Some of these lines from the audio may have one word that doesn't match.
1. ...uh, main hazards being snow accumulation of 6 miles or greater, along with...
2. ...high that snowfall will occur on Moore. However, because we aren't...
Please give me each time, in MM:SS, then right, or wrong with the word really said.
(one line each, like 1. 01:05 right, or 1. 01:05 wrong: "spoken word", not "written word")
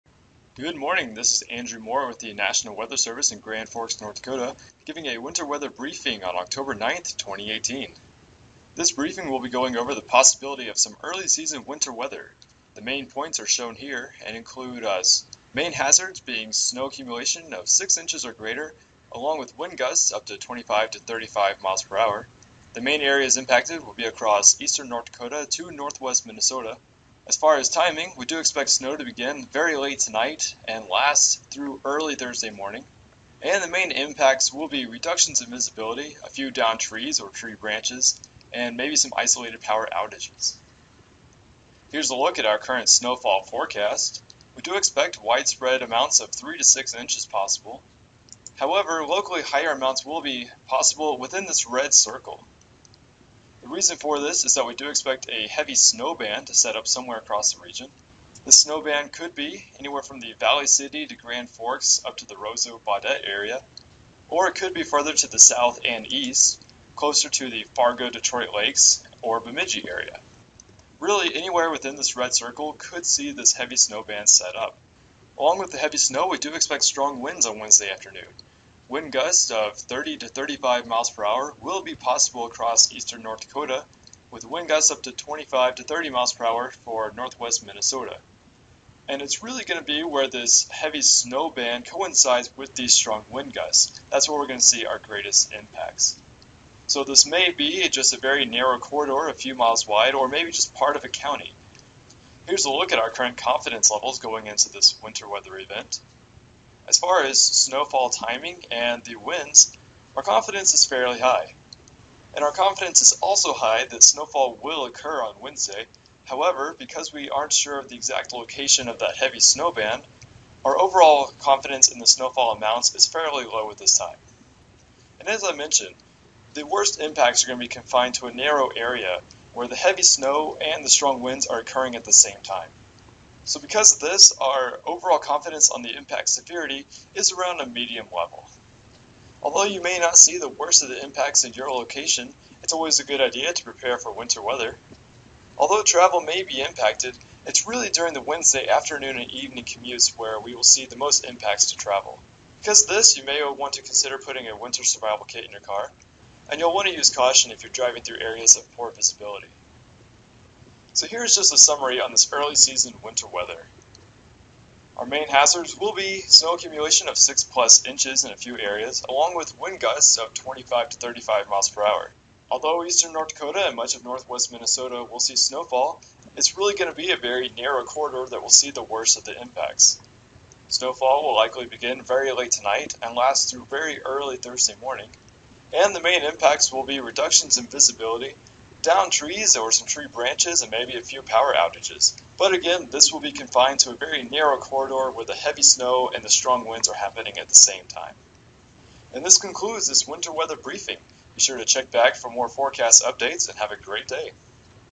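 1. 00:14 wrong: "inches", not "miles"
2. 01:53 wrong: "Wednesday", not "Moore".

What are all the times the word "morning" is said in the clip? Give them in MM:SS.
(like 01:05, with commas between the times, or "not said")
00:00, 00:32, 03:04.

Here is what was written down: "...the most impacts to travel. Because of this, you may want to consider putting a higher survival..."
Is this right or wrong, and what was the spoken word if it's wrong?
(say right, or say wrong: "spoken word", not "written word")
wrong: "winter", not "higher".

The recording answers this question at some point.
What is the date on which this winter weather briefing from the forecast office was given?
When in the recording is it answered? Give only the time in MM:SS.
00:06.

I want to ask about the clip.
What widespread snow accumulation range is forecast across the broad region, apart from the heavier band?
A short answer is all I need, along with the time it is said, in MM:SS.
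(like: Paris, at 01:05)
3 to 6 inches, at 00:46.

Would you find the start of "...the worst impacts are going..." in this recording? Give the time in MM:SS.
02:06.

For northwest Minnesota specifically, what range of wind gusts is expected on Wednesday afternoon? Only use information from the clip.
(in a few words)
25 to 30 mph.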